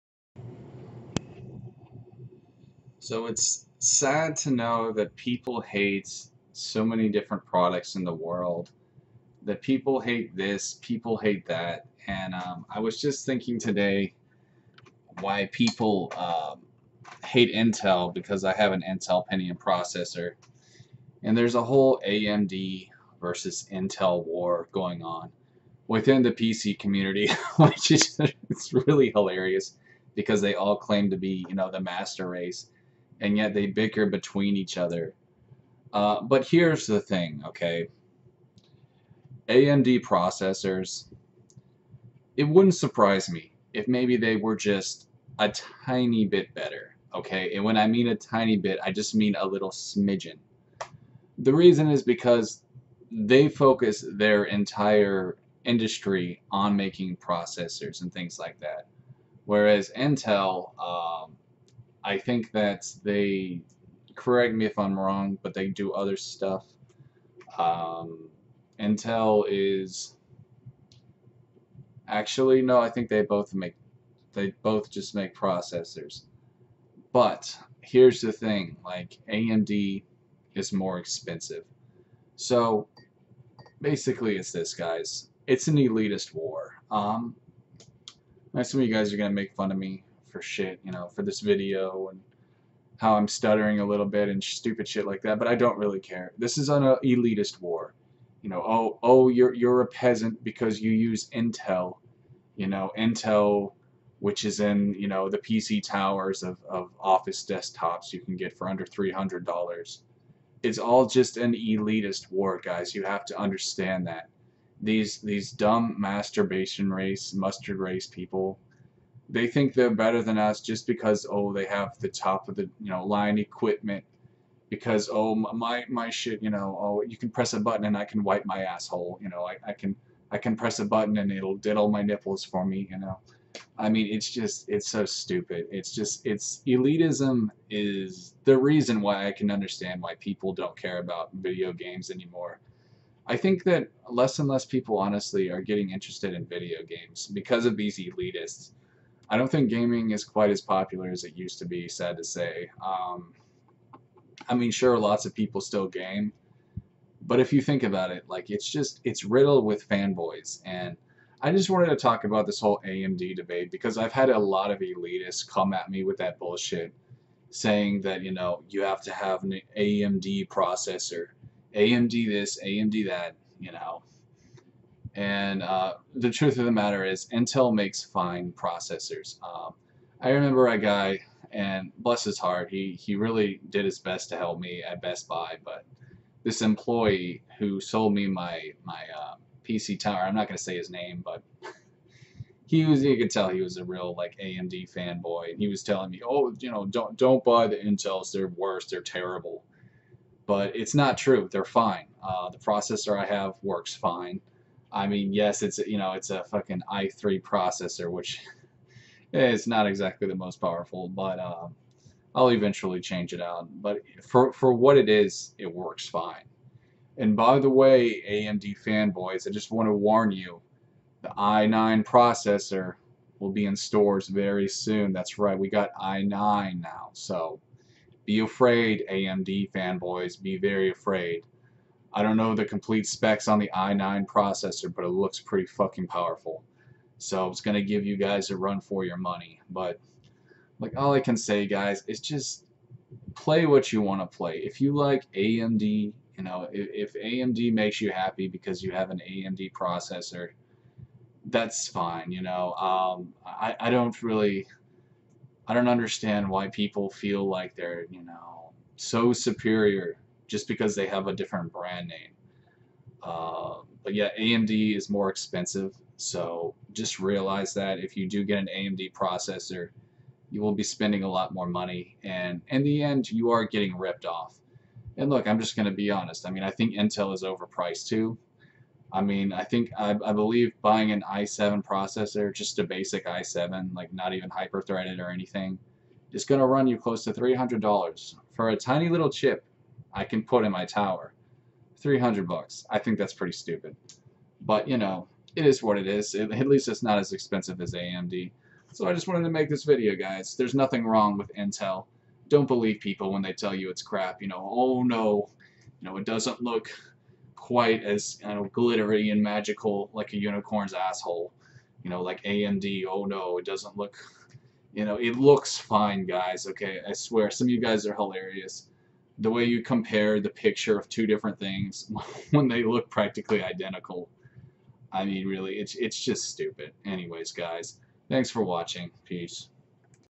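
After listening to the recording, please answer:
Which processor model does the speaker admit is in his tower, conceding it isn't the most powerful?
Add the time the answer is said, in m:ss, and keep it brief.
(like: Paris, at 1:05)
i3, at 3:26.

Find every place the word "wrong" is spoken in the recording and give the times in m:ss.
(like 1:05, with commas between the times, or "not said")
1:04, 5:01.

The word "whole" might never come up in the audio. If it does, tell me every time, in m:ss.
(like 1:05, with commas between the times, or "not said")
0:21, 2:42.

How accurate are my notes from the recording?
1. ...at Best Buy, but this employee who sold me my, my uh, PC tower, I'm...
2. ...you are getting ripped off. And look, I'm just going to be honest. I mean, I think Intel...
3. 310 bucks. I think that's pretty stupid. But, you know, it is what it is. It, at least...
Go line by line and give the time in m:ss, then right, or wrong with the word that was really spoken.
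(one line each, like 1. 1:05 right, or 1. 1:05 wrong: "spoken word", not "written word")
1. 3:04 right
2. 4:33 right
3. 4:51 wrong: "300", not "310".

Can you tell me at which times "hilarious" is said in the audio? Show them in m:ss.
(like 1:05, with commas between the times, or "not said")
0:29, 5:18.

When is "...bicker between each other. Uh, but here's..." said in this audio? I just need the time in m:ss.
0:33.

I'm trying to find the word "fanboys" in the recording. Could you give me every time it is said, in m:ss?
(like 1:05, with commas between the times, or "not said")
2:39, 3:14, 3:38, 3:49.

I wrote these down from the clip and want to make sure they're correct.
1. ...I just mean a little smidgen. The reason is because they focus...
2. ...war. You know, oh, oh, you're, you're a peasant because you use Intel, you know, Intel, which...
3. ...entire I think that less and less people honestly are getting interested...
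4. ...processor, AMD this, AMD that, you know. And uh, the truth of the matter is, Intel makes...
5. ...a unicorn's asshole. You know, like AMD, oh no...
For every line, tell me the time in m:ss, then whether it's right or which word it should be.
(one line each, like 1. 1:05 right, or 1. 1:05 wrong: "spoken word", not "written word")
1. 0:48 right
2. 1:37 right
3. 2:22 wrong: "anymore", not "entire"
4. 2:50 right
5. 5:10 right.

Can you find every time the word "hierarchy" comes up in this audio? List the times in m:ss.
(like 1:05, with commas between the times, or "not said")
not said.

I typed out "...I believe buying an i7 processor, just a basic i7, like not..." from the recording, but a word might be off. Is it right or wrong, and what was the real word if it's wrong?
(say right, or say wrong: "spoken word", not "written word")
right.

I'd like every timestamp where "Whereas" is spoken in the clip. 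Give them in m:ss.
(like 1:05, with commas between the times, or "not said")
0:59.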